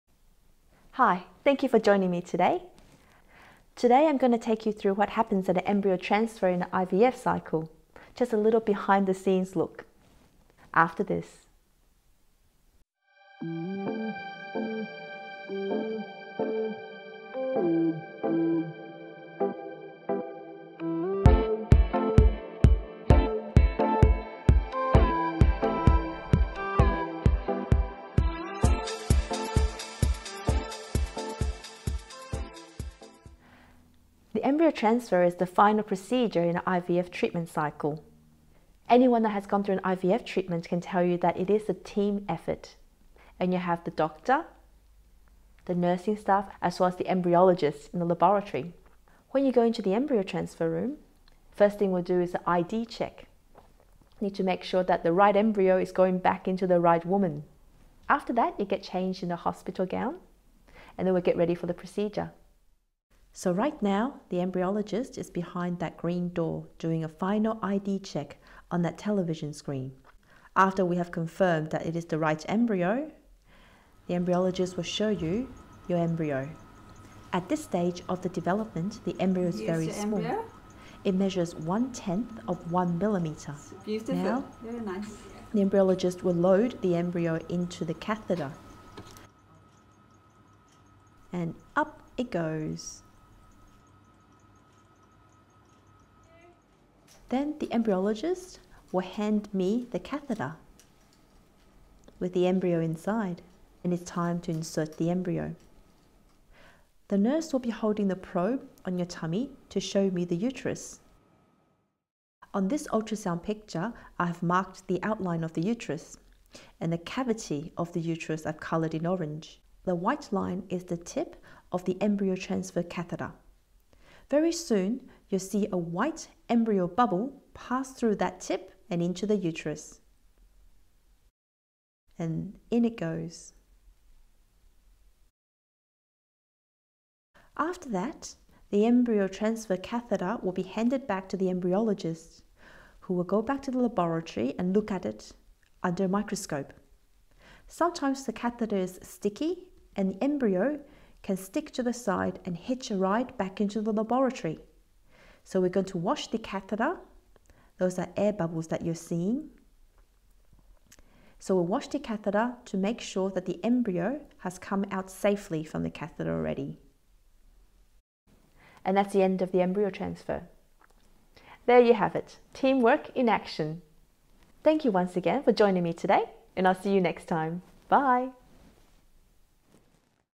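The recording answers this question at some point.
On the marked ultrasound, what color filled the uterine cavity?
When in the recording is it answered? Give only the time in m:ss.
1:59.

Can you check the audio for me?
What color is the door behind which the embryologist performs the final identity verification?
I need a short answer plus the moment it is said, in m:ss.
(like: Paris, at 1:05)
Green, at 1:05.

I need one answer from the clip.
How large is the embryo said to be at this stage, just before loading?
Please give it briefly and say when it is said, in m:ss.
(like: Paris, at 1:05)
1/10 of a millimeter, at 1:21.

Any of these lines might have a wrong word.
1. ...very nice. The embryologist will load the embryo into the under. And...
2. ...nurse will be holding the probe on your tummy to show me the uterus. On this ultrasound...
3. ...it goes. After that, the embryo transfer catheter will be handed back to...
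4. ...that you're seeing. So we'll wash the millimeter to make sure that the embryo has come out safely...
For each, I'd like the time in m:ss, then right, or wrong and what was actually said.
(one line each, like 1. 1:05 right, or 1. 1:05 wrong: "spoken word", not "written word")
1. 1:24 wrong: "catheter", not "under"
2. 1:47 right
3. 2:12 right
4. 2:38 wrong: "catheter", not "millimeter".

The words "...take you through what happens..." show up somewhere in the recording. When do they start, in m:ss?
0:04.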